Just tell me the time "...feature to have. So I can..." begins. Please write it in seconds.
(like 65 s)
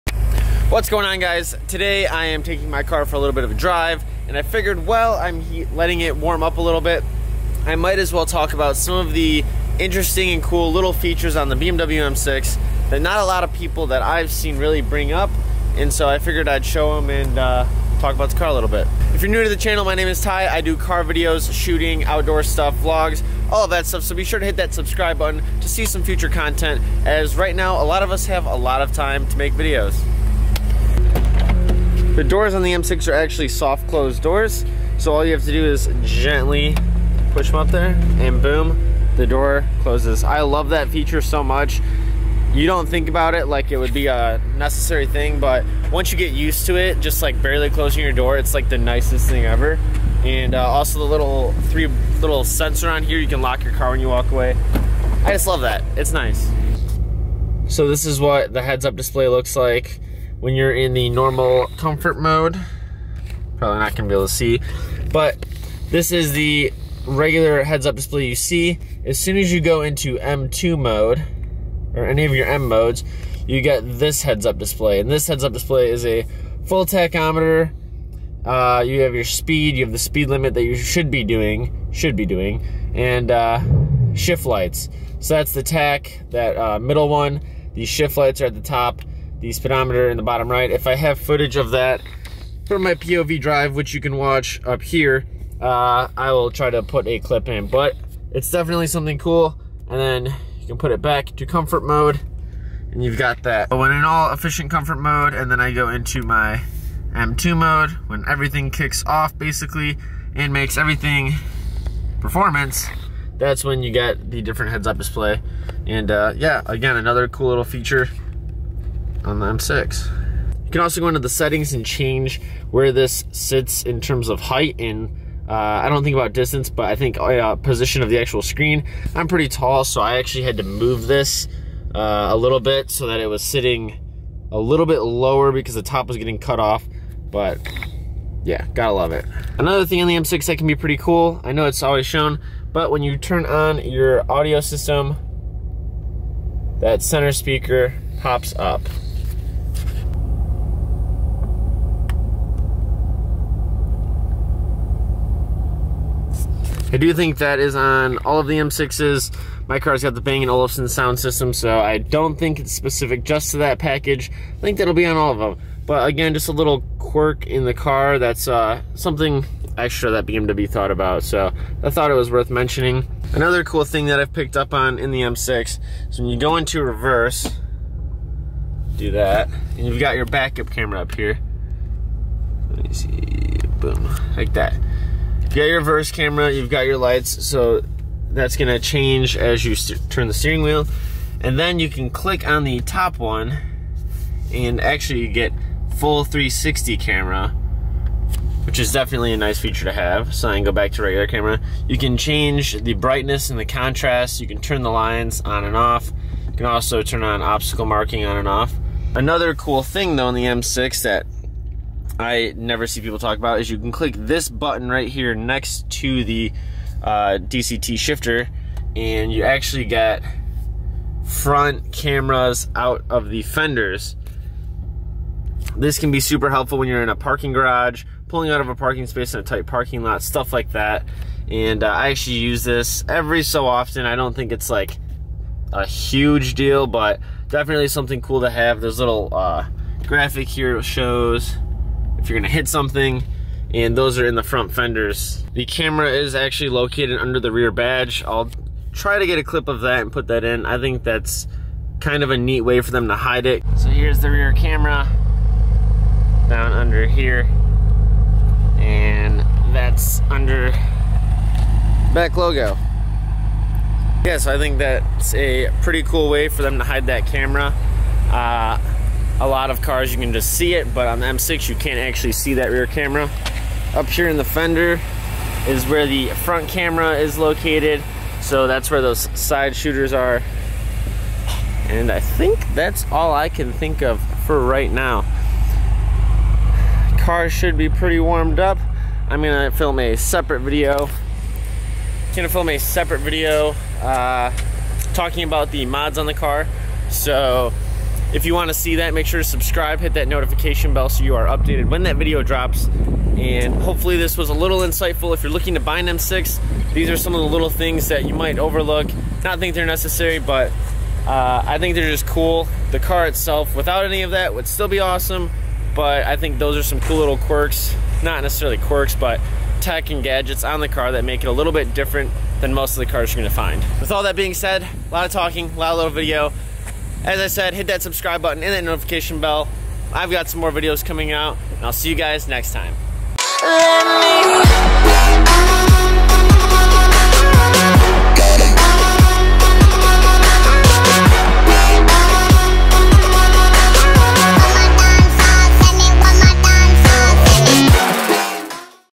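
199 s.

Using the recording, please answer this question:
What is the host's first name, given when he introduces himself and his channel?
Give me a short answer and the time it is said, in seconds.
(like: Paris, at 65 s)
Ty, at 20 s.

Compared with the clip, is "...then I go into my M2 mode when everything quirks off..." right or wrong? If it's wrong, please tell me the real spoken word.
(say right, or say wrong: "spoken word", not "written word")
wrong: "kicks", not "quirks".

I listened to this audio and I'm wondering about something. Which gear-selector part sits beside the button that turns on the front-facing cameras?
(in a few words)
DCT shifter.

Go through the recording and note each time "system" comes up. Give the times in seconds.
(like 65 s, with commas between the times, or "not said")
144 s, 161 s.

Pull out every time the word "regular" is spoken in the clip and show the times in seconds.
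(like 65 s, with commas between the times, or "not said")
67 s, 201 s.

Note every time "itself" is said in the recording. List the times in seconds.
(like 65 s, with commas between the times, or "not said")
313 s.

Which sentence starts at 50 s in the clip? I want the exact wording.
And uh, also the little three little sensor on here, you can lock your car when you walk away.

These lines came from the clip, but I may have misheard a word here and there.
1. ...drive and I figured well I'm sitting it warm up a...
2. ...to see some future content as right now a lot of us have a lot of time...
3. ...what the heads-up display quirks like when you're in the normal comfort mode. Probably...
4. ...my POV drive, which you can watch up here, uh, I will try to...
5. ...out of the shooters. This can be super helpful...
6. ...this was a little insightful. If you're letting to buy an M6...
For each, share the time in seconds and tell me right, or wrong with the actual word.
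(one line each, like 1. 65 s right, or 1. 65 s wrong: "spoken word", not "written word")
1. 3 s wrong: "letting", not "sitting"
2. 25 s right
3. 58 s wrong: "looks", not "quirks"
4. 92 s right
5. 222 s wrong: "fenders", not "shooters"
6. 304 s wrong: "looking", not "letting".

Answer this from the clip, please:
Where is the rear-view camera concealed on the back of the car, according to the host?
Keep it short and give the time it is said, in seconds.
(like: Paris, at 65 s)
Under the rear badge, at 247 s.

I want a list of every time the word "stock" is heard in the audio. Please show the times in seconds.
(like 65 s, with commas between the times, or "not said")
not said.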